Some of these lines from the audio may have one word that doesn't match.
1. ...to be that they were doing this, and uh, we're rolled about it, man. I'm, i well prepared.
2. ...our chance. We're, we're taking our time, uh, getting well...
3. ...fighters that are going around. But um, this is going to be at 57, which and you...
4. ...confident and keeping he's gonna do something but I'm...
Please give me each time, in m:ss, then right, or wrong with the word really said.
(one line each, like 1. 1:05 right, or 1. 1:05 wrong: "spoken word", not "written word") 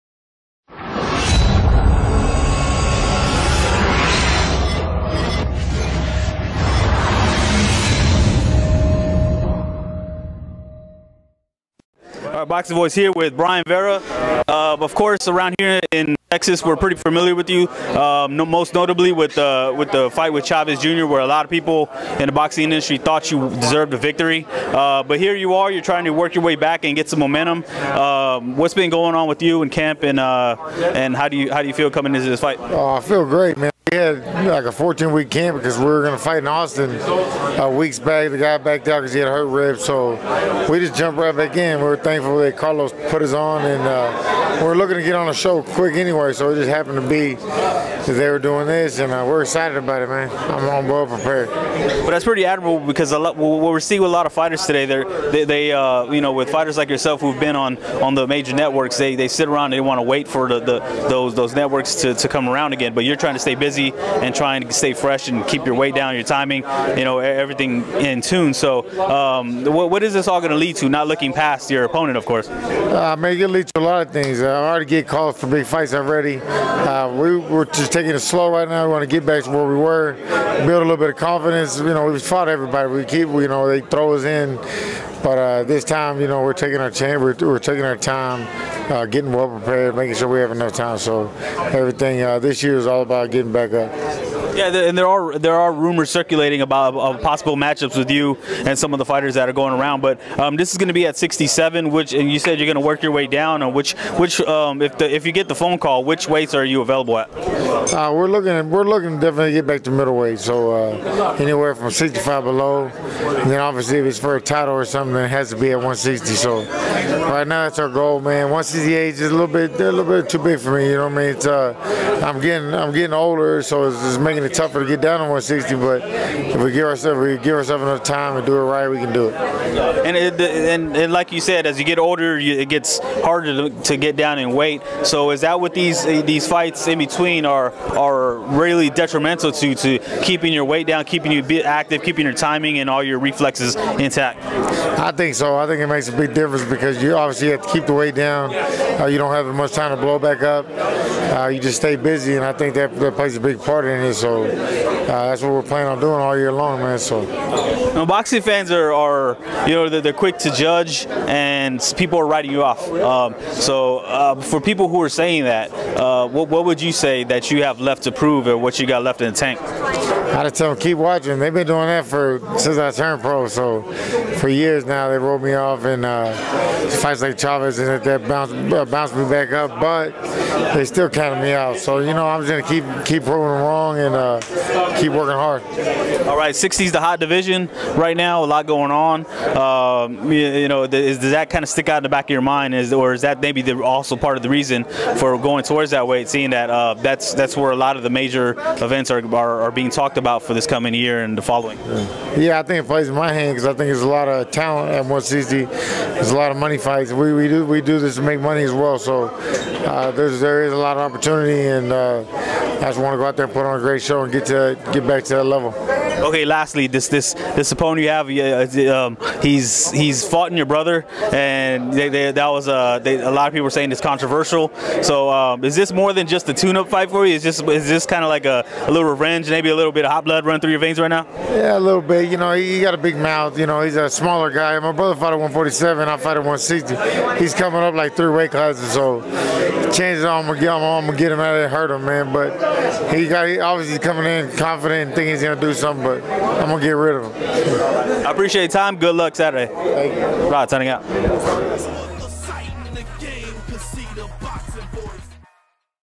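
1. 0:47 wrong: "excited", not "rolled"
2. 1:26 right
3. 1:39 wrong: "67", not "57"
4. 4:04 wrong: "thinking", not "keeping".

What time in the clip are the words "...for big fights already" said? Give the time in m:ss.
1:15.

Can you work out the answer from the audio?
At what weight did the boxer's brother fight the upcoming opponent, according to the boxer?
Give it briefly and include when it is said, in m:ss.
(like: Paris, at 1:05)
147, at 3:55.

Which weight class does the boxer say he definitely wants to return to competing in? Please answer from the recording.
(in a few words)
middleweight.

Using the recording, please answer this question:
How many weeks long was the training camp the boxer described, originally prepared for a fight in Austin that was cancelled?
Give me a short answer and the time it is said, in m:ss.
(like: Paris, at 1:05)
14, at 0:34.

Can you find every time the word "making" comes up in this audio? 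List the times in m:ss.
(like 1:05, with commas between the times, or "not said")
1:29, 2:04.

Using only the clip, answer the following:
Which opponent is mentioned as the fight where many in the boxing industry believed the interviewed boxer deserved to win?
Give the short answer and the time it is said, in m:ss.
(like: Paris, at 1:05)
Chavez Jr., at 0:20.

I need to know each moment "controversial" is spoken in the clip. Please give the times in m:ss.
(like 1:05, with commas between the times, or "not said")
3:43.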